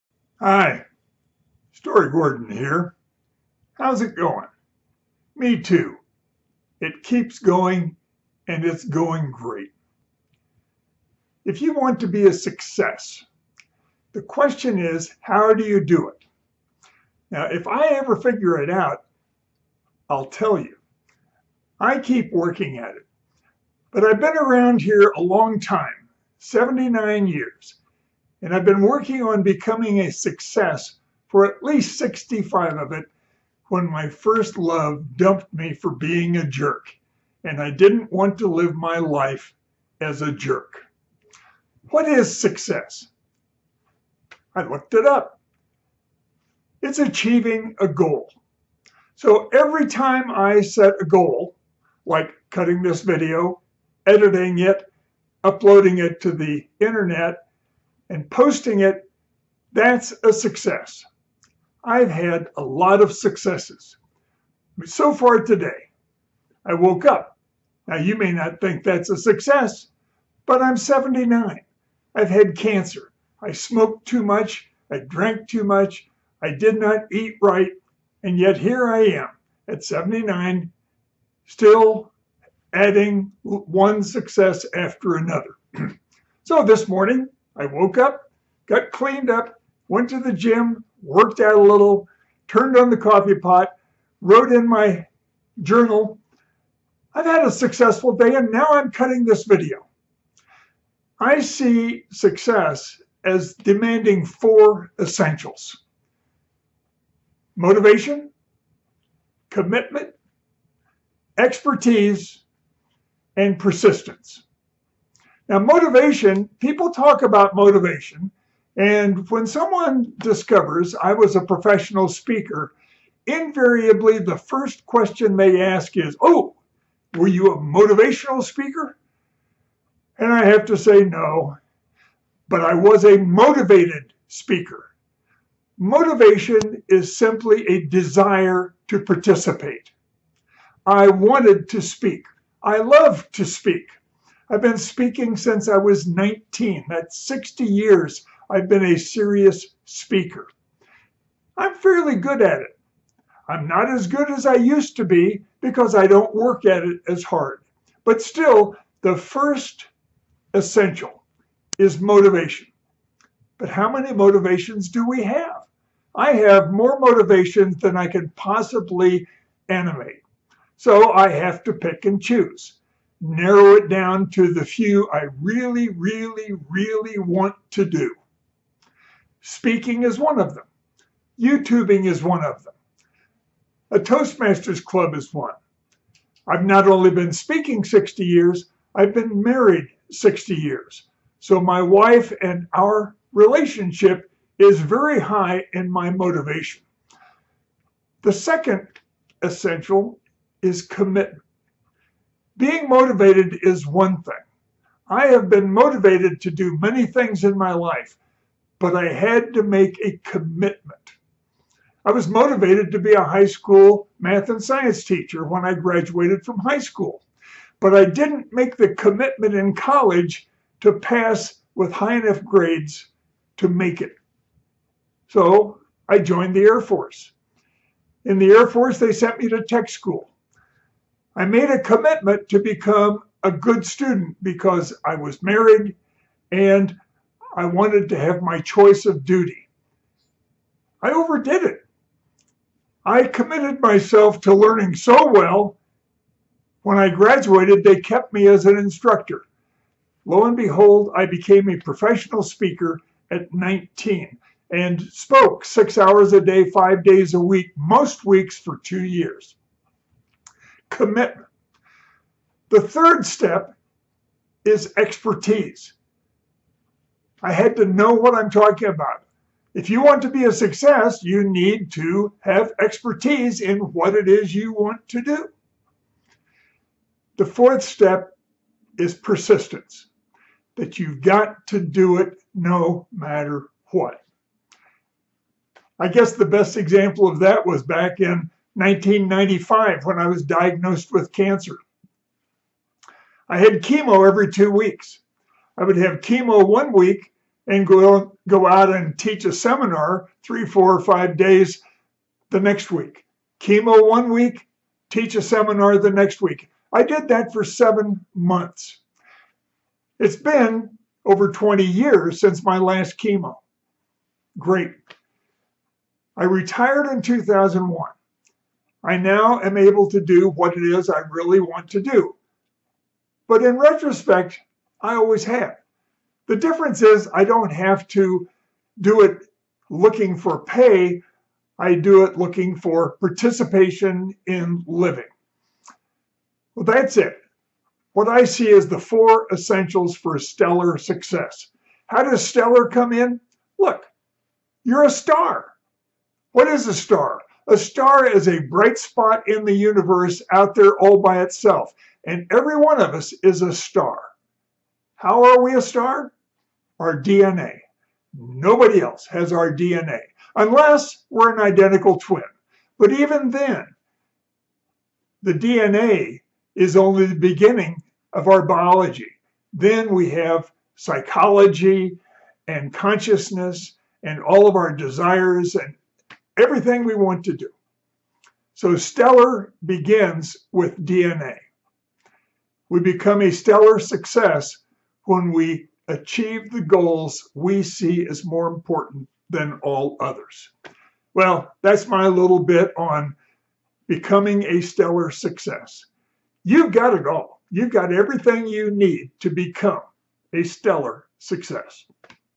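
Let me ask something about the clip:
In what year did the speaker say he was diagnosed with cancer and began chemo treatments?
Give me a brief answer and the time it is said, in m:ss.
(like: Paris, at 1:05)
1995, at 4:48.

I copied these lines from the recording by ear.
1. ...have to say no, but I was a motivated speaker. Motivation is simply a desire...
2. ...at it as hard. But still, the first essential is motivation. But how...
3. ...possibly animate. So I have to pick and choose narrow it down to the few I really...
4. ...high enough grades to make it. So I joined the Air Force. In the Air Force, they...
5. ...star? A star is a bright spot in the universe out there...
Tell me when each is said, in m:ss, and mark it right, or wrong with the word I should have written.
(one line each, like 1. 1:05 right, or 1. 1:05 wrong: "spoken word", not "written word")
1. 2:10 right
2. 2:36 right
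3. 2:48 right
4. 3:41 right
5. 5:46 right.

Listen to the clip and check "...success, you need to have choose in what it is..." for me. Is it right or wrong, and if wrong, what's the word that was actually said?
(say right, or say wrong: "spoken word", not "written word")
wrong: "expertise", not "choose".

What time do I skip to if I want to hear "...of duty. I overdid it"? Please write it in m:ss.
3:59.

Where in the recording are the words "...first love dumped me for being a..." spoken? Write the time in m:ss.
0:34.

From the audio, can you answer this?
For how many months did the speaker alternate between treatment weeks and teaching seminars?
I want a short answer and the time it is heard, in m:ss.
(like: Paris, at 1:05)
7, at 5:07.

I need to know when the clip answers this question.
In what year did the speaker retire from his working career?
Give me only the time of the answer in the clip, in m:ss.
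5:17.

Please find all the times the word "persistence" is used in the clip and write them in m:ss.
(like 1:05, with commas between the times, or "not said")
1:53, 4:39.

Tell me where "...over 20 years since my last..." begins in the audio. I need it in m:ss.
5:11.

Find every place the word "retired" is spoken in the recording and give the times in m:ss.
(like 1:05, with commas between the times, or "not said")
5:16.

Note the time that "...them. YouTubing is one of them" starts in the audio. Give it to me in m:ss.
3:00.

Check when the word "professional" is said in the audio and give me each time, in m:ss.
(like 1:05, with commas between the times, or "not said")
2:01, 4:11.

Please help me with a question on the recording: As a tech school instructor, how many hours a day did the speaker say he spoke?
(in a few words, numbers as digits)
6.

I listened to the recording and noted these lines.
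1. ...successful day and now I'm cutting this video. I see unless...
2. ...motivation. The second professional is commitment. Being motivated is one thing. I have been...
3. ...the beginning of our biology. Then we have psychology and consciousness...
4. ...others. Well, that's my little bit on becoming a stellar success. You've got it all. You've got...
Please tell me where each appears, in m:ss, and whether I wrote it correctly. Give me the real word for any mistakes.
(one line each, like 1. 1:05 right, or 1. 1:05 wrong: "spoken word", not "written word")
1. 1:37 wrong: "success", not "unless"
2. 3:16 wrong: "essential", not "professional"
3. 6:07 right
4. 6:30 right.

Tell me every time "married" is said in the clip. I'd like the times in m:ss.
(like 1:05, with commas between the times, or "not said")
3:09, 3:55.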